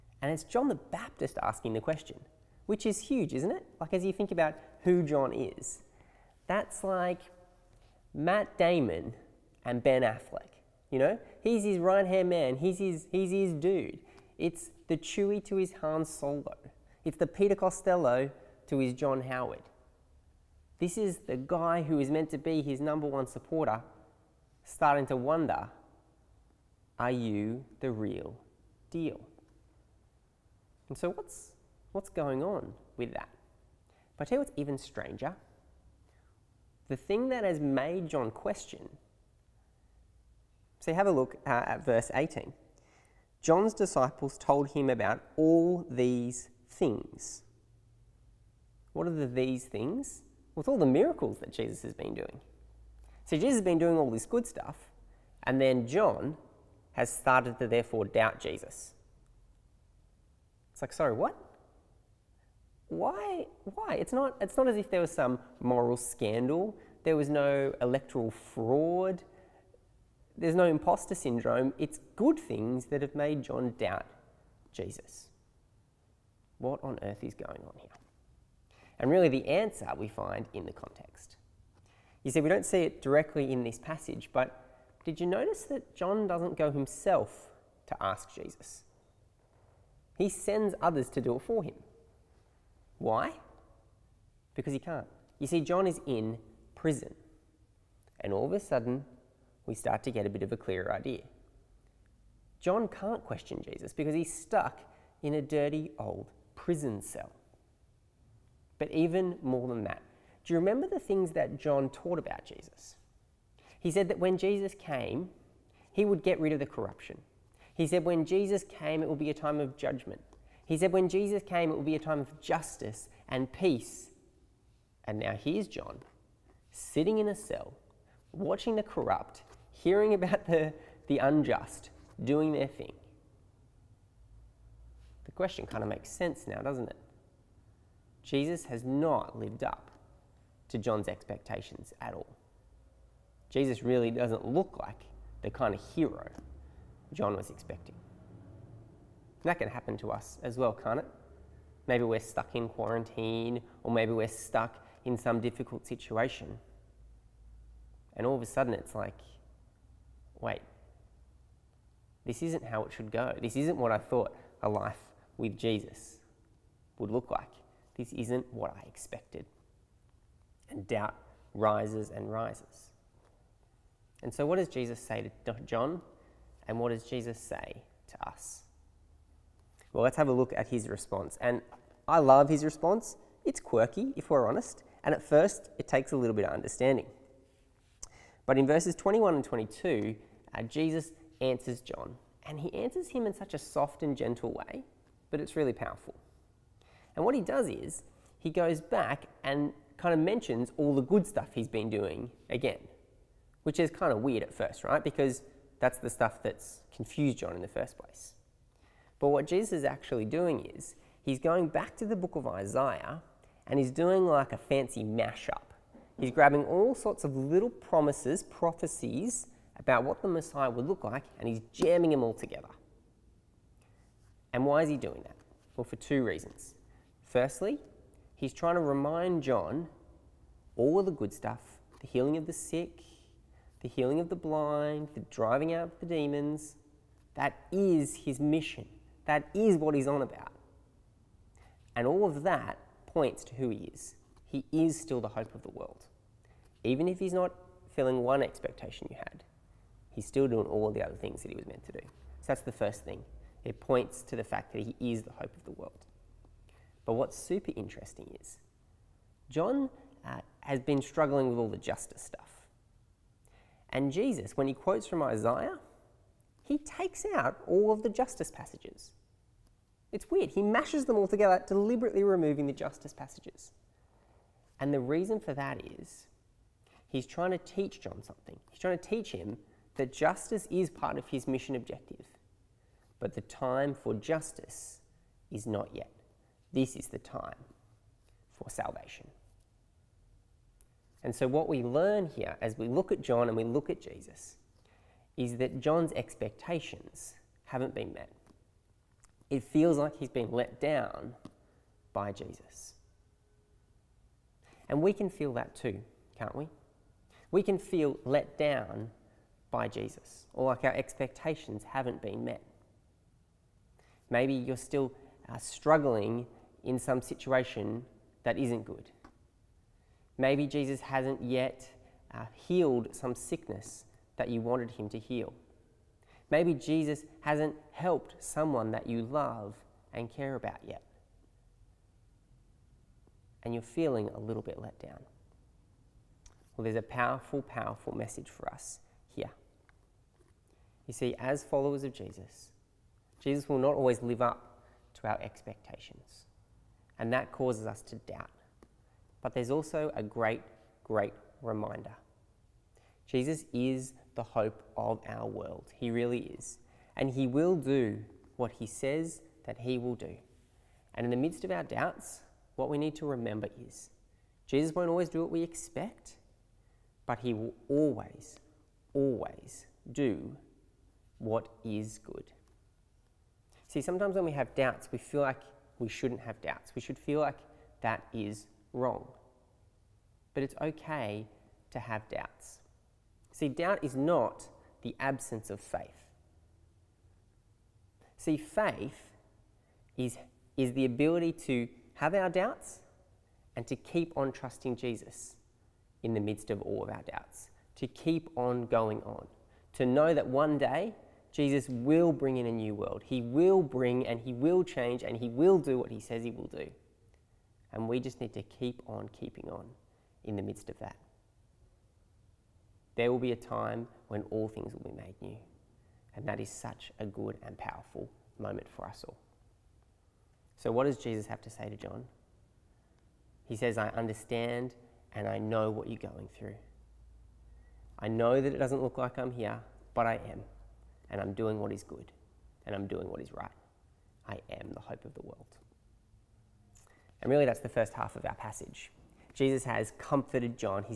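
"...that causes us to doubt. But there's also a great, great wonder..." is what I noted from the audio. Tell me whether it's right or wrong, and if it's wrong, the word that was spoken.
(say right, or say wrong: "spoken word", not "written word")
wrong: "reminder", not "wonder".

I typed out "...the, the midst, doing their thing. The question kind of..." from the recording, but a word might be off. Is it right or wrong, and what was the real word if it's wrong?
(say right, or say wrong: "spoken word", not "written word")
wrong: "unjust", not "midst".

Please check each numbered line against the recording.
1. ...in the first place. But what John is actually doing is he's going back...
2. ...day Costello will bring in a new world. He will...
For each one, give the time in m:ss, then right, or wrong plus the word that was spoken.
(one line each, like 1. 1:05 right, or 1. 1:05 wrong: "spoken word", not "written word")
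1. 3:27 wrong: "Jesus", not "John"
2. 6:40 wrong: "Jesus", not "Costello".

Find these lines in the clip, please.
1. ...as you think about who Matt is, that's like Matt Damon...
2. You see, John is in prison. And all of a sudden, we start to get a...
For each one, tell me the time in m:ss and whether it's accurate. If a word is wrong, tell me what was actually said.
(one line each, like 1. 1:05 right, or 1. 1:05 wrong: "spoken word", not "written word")
1. 0:03 wrong: "John", not "Matt"
2. 1:35 right.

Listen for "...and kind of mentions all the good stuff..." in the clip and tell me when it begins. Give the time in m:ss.
3:19.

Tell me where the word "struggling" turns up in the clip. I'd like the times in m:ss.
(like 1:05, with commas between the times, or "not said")
4:21, 5:15.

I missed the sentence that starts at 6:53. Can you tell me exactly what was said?
There will be a time when all things will be made new.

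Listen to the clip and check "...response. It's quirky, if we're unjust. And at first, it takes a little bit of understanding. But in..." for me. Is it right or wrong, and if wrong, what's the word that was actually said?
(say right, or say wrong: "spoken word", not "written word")
wrong: "honest", not "unjust".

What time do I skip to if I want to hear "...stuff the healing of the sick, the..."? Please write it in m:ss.
3:51.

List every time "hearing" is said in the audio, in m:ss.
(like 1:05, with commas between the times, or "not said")
2:09.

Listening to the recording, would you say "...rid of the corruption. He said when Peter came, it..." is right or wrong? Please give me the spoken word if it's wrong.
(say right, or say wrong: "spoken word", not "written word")
wrong: "Jesus", not "Peter".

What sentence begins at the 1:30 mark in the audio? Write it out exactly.
He sends others to do it for him.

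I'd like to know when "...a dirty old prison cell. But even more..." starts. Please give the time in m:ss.
1:45.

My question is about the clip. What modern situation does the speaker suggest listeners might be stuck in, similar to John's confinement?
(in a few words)
quarantine.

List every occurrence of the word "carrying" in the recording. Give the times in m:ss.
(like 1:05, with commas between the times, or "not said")
not said.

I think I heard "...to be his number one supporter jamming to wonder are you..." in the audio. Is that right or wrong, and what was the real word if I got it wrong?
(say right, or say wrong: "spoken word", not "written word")
wrong: "starting", not "jamming".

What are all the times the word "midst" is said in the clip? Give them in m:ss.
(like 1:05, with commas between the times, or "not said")
6:01, 6:36, 6:50.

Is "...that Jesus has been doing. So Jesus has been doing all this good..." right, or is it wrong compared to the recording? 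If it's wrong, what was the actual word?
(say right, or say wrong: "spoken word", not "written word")
right.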